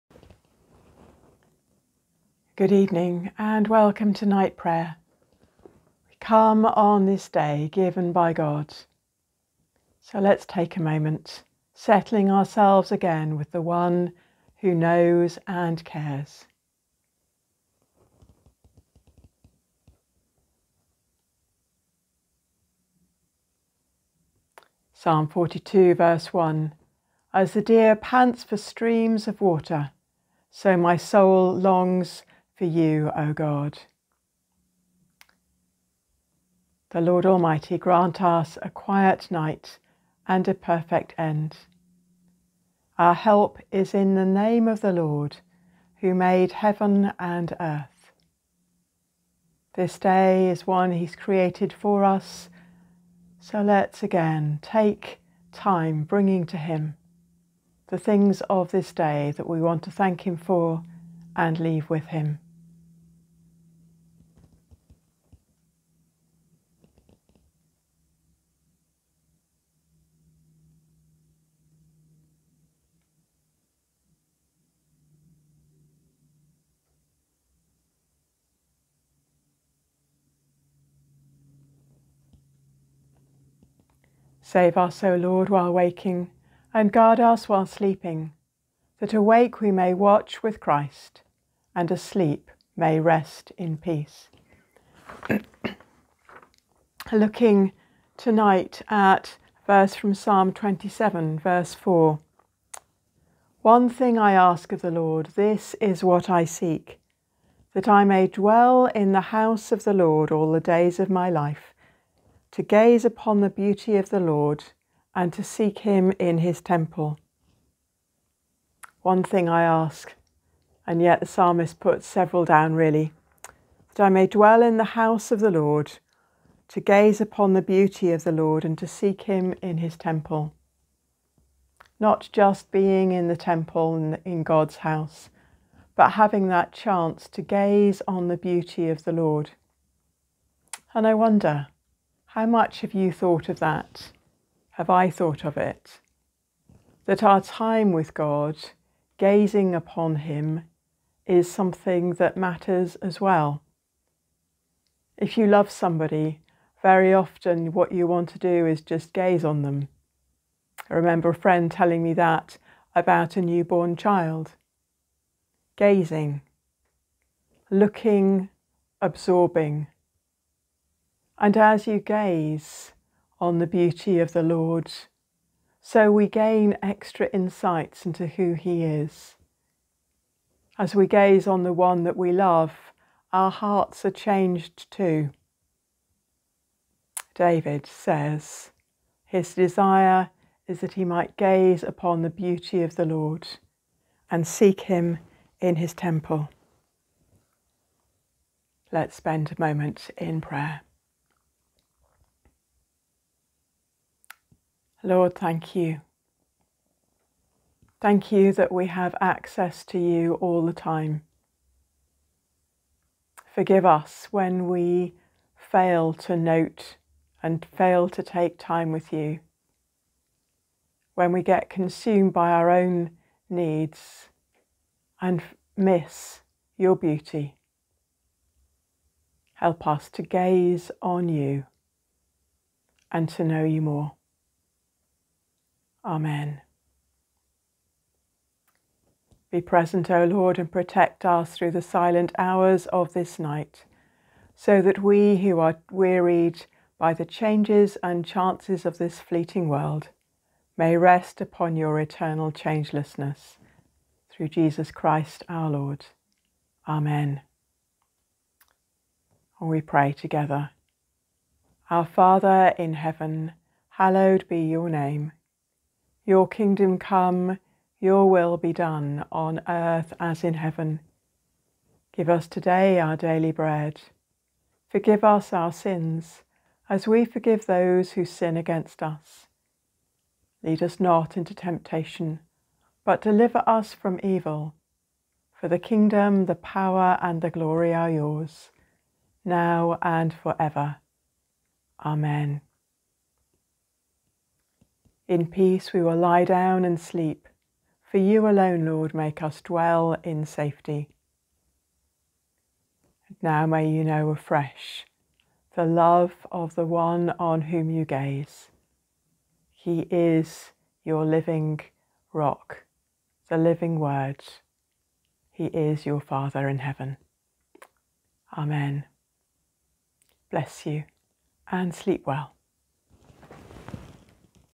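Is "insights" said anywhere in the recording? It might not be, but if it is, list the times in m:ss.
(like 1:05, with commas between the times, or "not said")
2:57.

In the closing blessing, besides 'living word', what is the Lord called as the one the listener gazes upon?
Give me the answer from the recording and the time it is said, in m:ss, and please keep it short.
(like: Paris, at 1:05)
living rock, at 5:11.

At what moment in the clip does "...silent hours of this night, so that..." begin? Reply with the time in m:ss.
4:01.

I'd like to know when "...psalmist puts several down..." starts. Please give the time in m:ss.
2:01.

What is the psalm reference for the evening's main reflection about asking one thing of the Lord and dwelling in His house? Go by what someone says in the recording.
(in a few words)
Psalm 27, verse 4.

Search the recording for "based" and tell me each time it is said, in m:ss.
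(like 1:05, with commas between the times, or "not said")
not said.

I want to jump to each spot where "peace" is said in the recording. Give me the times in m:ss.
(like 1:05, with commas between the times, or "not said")
1:33, 4:55.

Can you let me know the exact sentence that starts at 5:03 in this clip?
And now may you know afresh the love of the one on whom you gaze.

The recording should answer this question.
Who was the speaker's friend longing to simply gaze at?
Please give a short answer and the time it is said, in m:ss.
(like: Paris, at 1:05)
a newborn child, at 2:43.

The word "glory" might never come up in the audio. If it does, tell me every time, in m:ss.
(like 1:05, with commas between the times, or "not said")
4:47.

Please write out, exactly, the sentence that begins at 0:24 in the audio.
Psalm 42, verse 1 As the deer pants for streams of water, so my soul longs for you, O God.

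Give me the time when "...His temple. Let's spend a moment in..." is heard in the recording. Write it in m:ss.
3:15.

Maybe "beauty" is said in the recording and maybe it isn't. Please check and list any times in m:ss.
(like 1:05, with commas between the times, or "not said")
1:53, 2:07, 2:18, 2:53, 3:12, 3:46.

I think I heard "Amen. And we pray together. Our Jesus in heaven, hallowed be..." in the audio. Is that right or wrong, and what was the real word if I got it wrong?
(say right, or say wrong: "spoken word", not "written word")
wrong: "Father", not "Jesus".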